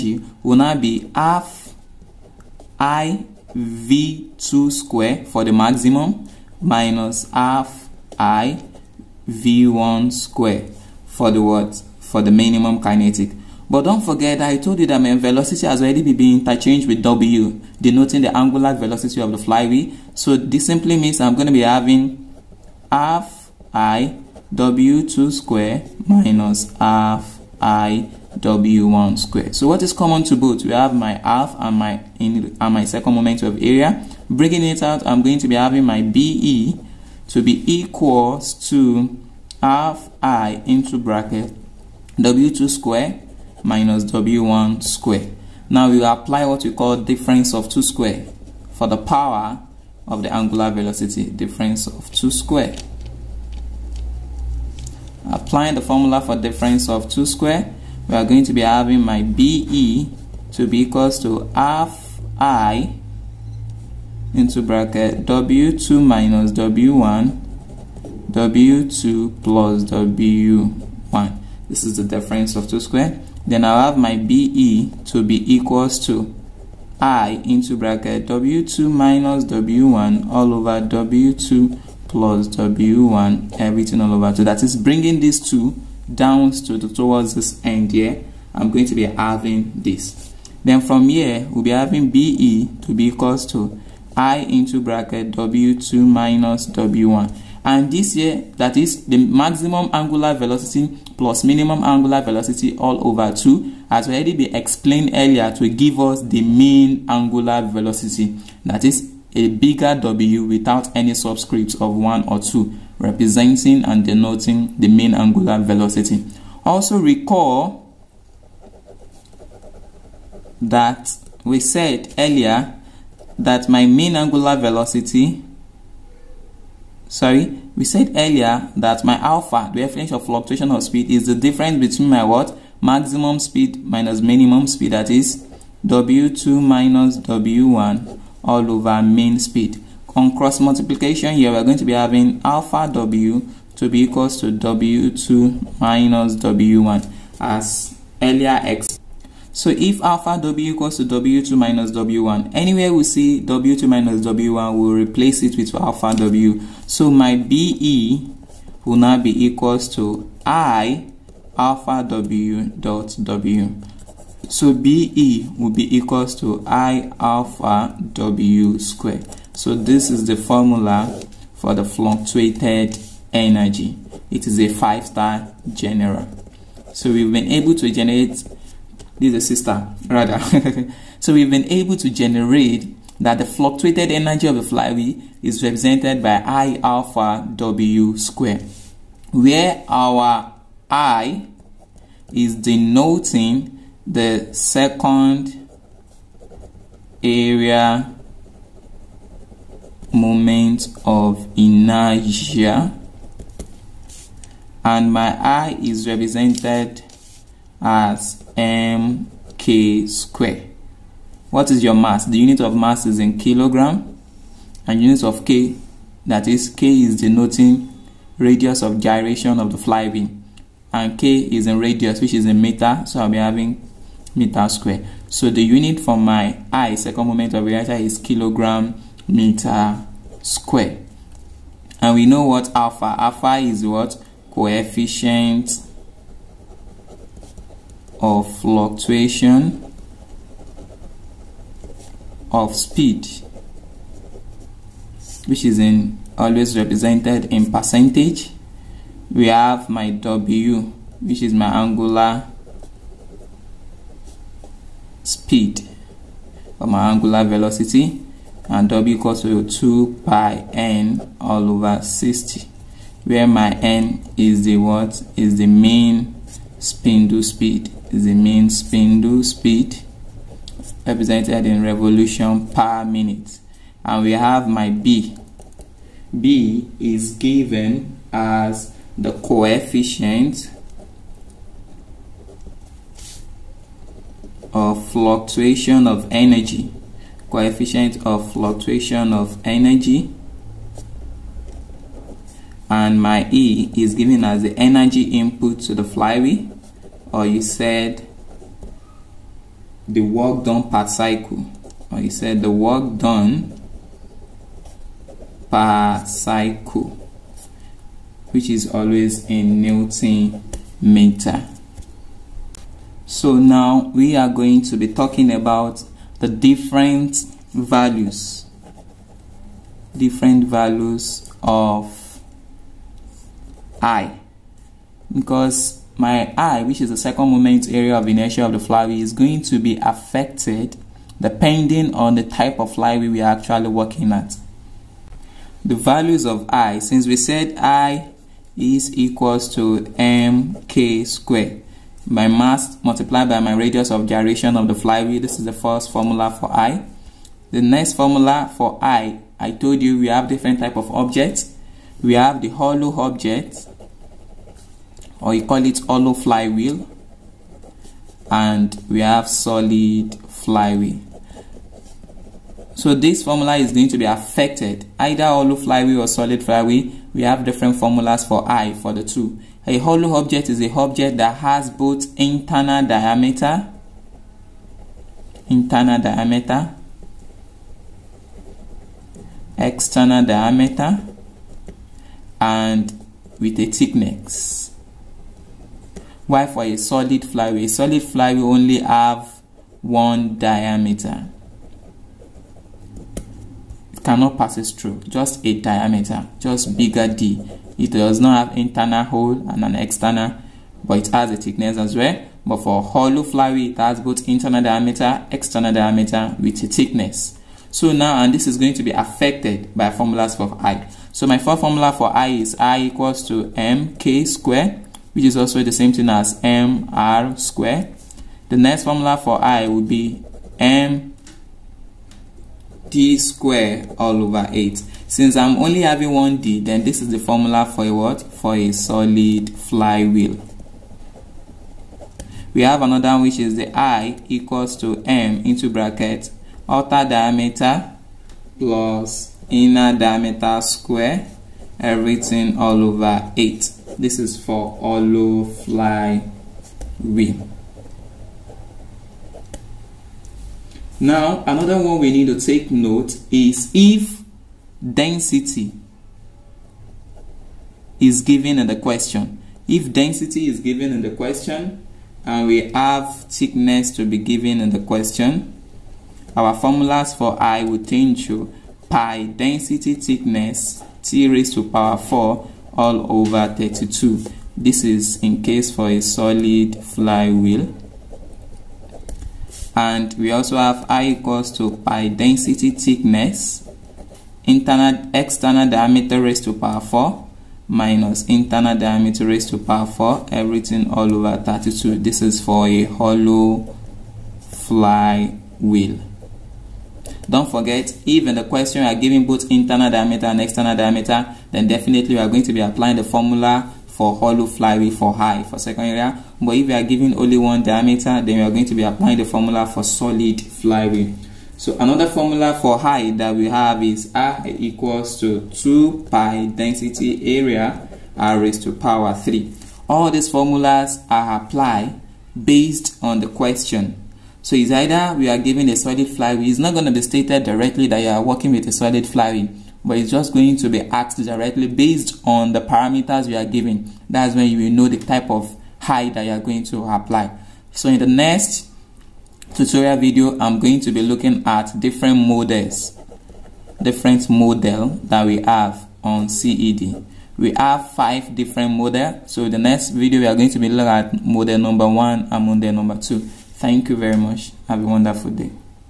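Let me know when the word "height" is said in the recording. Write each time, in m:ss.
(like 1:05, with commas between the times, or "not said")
8:32, 8:56.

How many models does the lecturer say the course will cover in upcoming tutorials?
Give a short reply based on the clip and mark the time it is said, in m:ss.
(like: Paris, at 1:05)
5, at 9:08.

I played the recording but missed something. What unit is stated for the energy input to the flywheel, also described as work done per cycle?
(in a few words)
Newton meter.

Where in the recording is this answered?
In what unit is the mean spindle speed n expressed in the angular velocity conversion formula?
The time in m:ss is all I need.
4:31.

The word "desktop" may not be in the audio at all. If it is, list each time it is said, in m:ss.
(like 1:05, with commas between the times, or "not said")
not said.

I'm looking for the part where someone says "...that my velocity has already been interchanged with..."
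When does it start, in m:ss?
0:14.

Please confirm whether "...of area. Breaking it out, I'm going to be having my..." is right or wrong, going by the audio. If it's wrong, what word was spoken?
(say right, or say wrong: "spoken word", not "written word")
right.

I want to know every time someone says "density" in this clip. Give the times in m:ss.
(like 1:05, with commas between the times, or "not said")
7:35, 7:40, 7:49, 8:02, 8:36.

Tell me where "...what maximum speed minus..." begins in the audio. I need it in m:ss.
2:12.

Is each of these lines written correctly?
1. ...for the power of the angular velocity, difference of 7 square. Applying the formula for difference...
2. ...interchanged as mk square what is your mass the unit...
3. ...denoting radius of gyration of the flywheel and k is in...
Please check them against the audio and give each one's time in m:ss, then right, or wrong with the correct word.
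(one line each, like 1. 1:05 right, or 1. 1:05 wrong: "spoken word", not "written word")
1. 0:48 wrong: "2", not "7"
2. 3:26 wrong: "represented", not "interchanged"
3. 3:37 right.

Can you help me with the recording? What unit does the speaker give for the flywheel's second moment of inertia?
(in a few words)
kilogram meter square.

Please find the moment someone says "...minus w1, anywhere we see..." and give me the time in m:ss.
2:31.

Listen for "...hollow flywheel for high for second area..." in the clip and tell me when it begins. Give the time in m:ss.
8:24.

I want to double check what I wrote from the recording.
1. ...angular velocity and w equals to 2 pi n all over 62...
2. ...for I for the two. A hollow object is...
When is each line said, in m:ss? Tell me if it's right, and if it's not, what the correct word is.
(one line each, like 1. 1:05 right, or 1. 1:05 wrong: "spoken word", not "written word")
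1. 4:17 wrong: "60", not "62"
2. 6:08 right.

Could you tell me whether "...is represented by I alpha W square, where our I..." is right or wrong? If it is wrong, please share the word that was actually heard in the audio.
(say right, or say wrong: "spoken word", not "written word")
right.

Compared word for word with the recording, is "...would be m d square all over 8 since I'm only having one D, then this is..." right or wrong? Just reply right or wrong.
right.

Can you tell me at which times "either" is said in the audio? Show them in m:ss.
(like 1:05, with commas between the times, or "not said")
6:05, 8:44.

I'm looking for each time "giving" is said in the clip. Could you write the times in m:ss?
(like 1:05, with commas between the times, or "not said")
8:19, 8:27.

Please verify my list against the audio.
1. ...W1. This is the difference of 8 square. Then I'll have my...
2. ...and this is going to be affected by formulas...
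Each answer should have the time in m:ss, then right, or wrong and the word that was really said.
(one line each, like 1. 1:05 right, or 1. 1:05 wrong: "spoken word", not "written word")
1. 1:09 wrong: "2", not "8"
2. 6:48 right.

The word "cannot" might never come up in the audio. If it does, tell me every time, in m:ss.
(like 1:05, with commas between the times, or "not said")
6:34.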